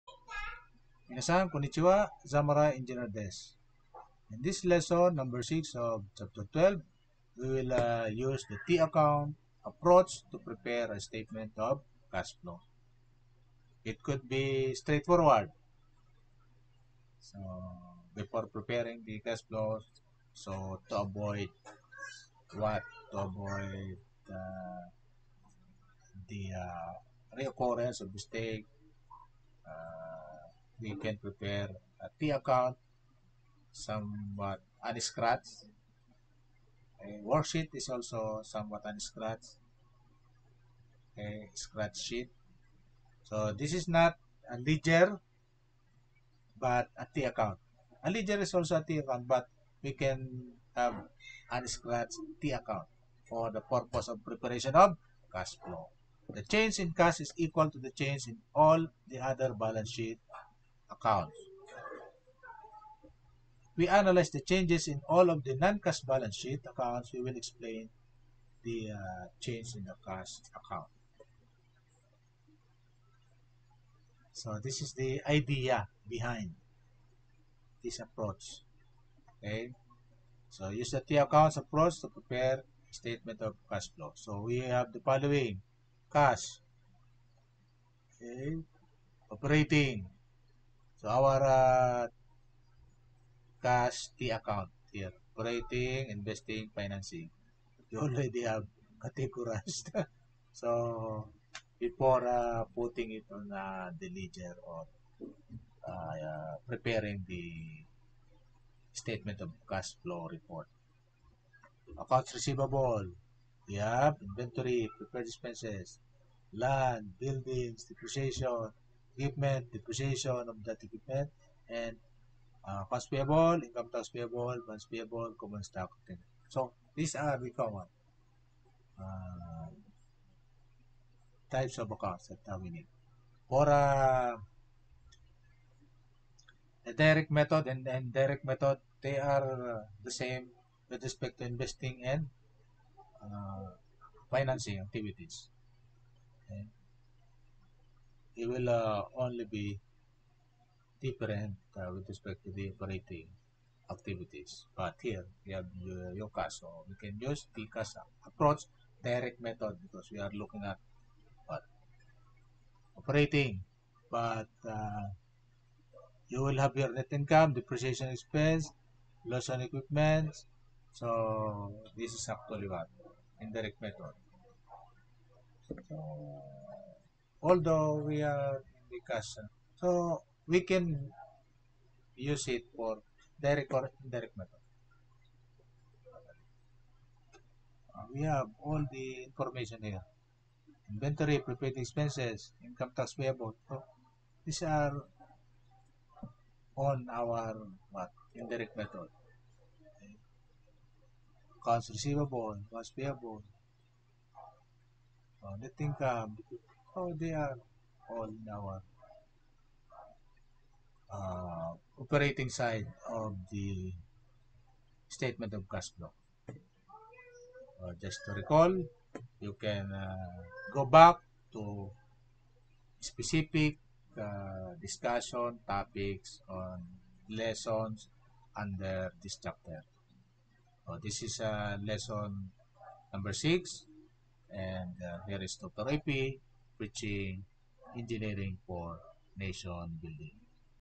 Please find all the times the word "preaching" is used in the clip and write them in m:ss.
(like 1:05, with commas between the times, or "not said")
3:56.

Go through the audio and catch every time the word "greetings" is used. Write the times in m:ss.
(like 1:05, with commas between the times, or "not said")
not said.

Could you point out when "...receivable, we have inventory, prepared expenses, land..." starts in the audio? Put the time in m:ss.
1:52.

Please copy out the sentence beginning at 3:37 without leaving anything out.
Uh, just to recall, you can uh, go back to specific uh, discussion topics on lessons under this chapter.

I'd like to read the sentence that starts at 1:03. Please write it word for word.
We analyze the changes in all of the non-cash balance sheet accounts.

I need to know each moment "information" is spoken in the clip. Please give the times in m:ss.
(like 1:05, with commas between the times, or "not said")
3:09.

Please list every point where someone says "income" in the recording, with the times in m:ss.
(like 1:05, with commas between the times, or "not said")
2:03, 2:47, 3:12, 3:25.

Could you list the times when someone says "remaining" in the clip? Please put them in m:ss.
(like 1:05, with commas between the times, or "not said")
not said.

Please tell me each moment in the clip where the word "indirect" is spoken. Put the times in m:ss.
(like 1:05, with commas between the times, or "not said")
2:17, 2:53, 3:04, 3:18.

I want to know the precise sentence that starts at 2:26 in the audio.
Okay it will uh, only be different uh, with respect to the operating activities.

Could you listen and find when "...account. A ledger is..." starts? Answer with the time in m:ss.
0:47.